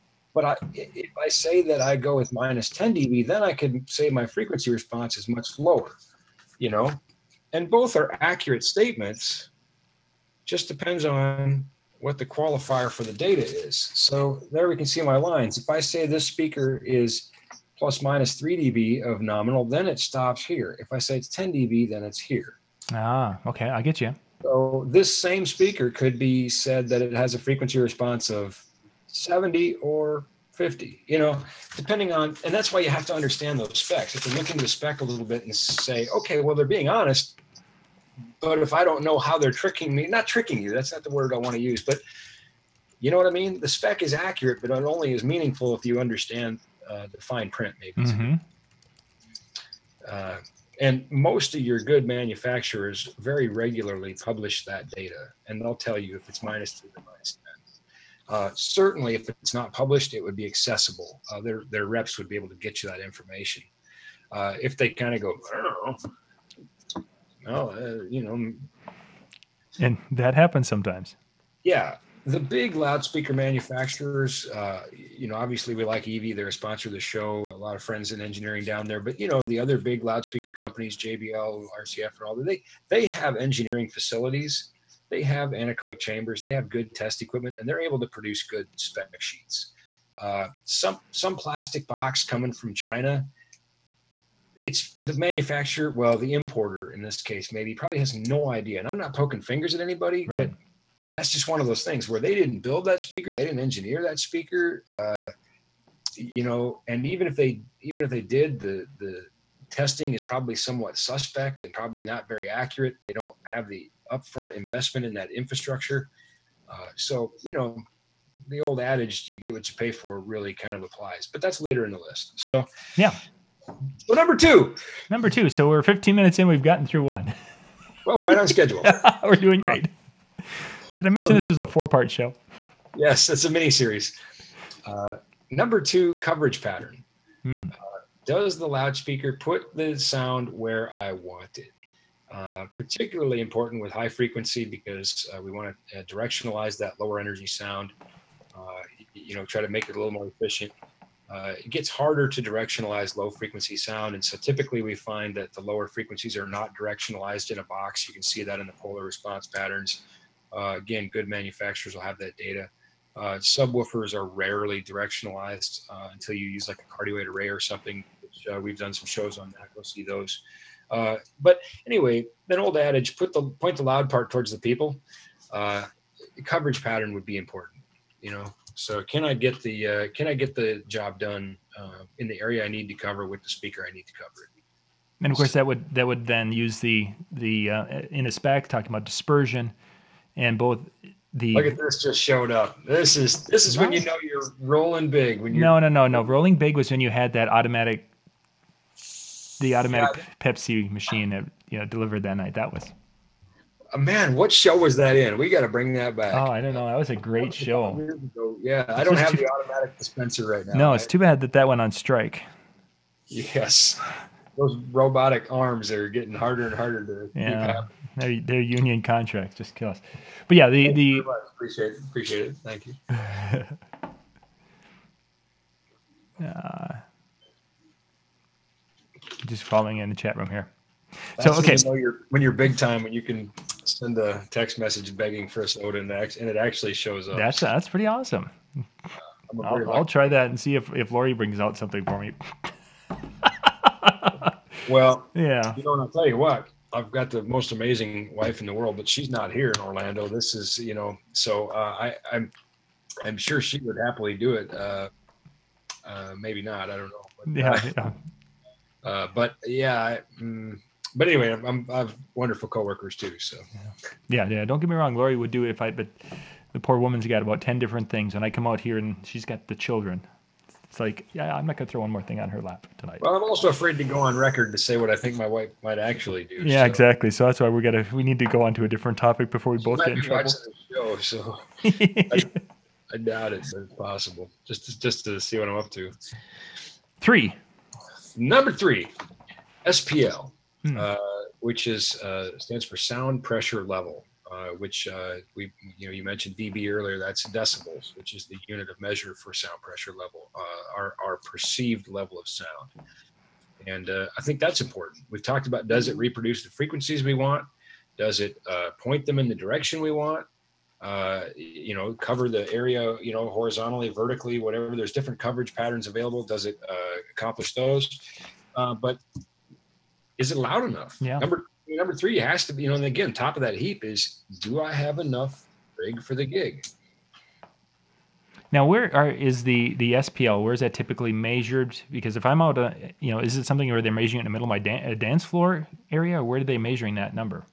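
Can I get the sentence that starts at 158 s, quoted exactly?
You can see that in the polar response patterns.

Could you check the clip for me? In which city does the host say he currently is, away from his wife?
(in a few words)
Orlando.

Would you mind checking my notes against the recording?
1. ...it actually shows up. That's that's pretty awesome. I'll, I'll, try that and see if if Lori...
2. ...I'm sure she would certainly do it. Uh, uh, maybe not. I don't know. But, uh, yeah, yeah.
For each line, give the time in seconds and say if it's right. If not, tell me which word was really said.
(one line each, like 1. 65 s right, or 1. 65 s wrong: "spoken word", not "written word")
1. 236 s right
2. 253 s wrong: "happily", not "certainly".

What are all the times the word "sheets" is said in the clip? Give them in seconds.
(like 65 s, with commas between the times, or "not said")
89 s.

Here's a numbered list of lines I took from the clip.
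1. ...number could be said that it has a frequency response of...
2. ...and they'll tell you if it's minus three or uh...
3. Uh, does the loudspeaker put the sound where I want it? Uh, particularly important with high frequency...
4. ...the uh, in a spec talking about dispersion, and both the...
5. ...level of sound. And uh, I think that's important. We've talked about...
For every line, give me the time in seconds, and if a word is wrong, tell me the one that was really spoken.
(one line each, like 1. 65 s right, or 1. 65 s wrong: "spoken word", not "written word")
1. 25 s wrong: "speaker", not "number"
2. 55 s right
3. 137 s right
4. 187 s right
5. 302 s right.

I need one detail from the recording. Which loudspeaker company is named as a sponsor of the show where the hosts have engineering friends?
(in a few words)
EV.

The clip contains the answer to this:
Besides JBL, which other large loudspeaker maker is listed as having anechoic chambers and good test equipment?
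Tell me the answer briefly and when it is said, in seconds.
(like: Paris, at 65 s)
RCF, at 81 s.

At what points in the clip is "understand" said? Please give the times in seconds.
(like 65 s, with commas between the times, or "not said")
33 s, 45 s.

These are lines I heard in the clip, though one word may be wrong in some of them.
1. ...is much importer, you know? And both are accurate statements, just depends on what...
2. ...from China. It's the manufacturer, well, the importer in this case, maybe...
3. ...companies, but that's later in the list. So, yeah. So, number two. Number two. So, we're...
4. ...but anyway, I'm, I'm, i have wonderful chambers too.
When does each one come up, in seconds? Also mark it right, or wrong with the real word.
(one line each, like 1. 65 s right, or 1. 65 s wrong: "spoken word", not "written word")
1. 5 s wrong: "lower", not "importer"
2. 92 s right
3. 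120 s wrong: "applies", not "companies"
4. 261 s wrong: "coworkers", not "chambers".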